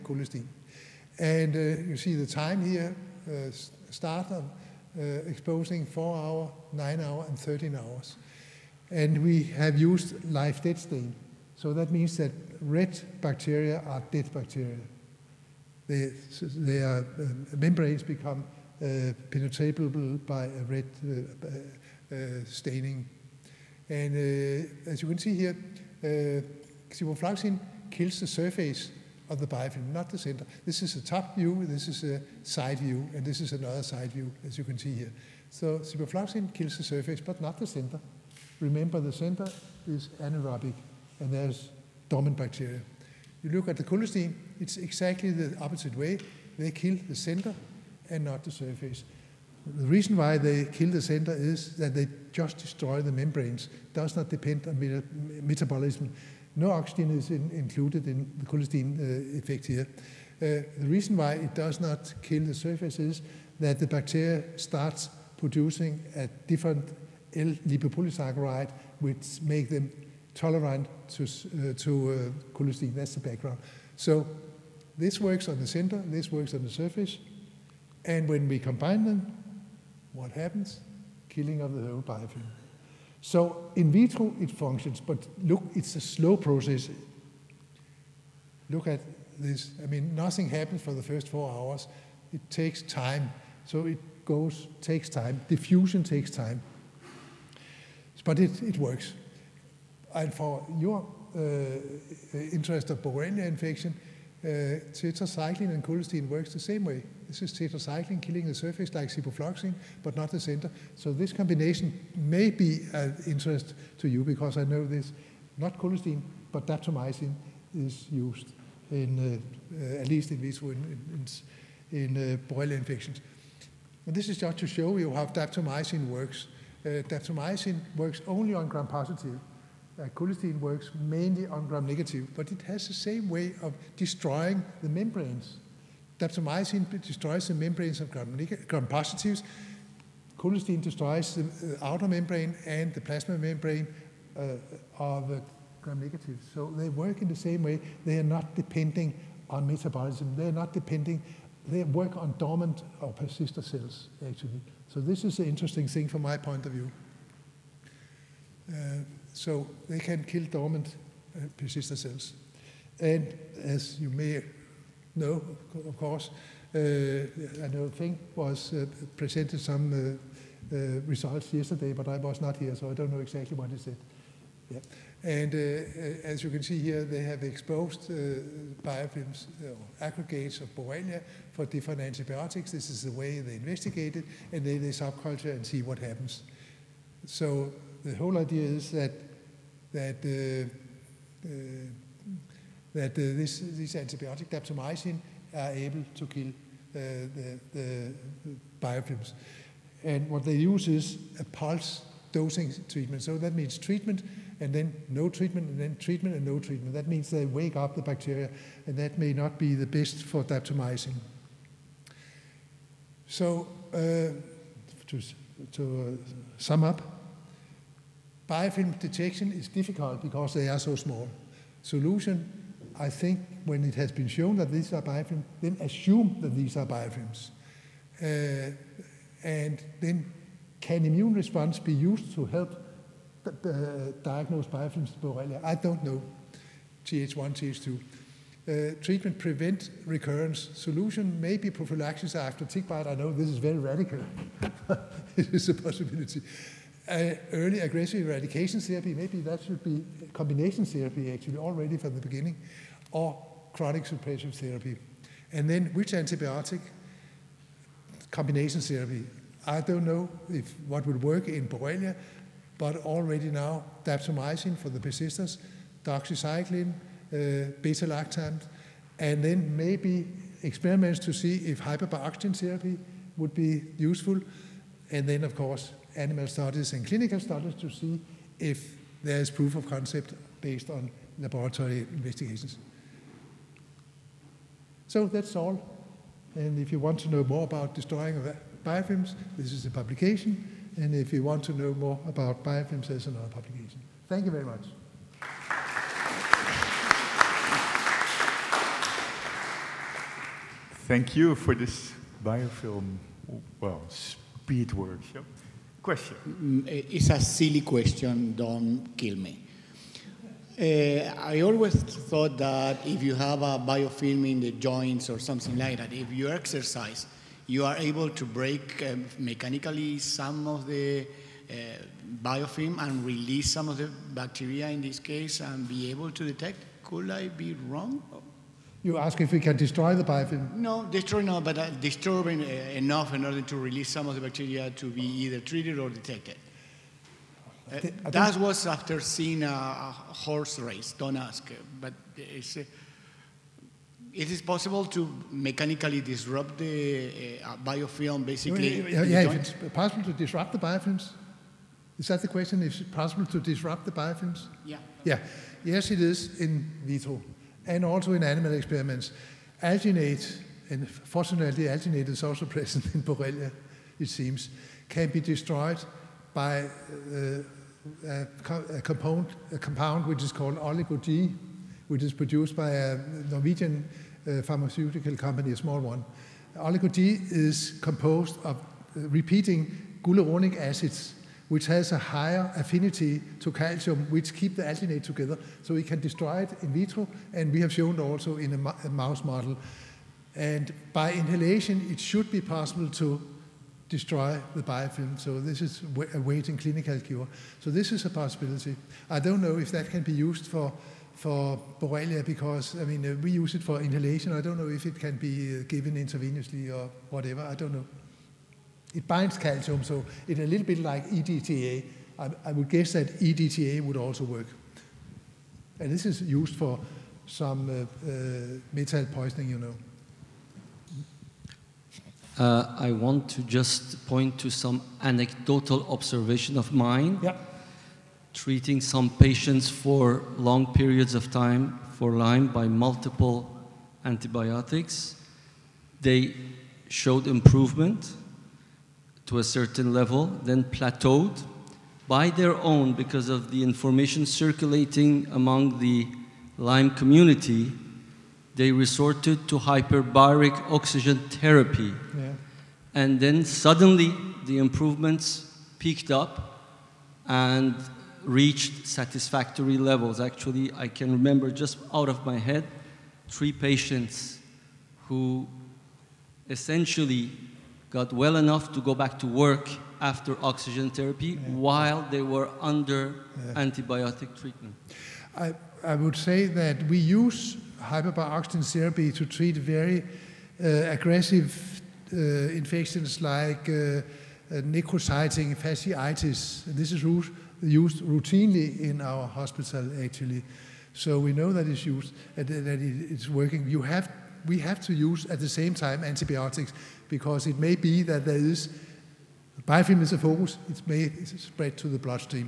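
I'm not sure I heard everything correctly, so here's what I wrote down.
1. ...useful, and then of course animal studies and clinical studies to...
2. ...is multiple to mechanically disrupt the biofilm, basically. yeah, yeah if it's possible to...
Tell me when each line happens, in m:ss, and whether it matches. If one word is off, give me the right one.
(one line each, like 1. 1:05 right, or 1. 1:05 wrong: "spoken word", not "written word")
1. 4:33 right
2. 5:44 wrong: "possible", not "multiple".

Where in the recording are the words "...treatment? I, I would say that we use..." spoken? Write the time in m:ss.
7:54.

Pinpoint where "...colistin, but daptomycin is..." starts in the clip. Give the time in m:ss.
1:55.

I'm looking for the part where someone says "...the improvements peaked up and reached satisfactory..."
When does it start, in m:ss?
7:34.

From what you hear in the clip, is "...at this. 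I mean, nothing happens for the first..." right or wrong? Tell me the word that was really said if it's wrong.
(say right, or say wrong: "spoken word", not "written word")
right.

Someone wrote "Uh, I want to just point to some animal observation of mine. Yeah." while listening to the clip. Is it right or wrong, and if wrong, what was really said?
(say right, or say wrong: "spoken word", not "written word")
wrong: "anecdotal", not "animal".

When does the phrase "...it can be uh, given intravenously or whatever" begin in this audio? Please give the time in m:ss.
6:45.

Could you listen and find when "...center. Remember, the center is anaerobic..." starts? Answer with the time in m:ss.
0:37.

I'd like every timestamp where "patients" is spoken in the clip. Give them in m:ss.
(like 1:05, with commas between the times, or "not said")
7:09, 7:43.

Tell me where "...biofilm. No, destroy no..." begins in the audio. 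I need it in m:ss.
5:30.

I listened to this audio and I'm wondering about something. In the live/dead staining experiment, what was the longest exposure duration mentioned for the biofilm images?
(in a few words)
13 hours.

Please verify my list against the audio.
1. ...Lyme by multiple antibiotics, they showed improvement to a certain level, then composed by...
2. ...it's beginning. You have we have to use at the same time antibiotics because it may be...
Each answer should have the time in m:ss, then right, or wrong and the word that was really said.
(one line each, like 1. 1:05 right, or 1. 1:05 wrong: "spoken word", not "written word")
1. 7:12 wrong: "plateaued", not "composed"
2. 8:13 wrong: "working", not "beginning".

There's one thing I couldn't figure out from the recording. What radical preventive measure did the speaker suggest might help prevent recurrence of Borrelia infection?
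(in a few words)
Prophylaxis after tick bite.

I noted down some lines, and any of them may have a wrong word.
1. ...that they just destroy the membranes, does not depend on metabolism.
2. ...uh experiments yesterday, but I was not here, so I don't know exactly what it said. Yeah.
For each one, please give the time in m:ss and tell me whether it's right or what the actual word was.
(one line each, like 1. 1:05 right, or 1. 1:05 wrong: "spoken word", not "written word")
1. 0:51 right
2. 2:50 wrong: "results", not "experiments".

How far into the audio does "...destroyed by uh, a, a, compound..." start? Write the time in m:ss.
6:05.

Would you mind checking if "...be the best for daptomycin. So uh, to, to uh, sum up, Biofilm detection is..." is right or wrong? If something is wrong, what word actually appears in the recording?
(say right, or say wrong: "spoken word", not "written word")
right.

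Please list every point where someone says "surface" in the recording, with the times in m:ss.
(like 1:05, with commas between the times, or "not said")
0:28, 0:36, 0:48, 1:02, 1:16, 1:48.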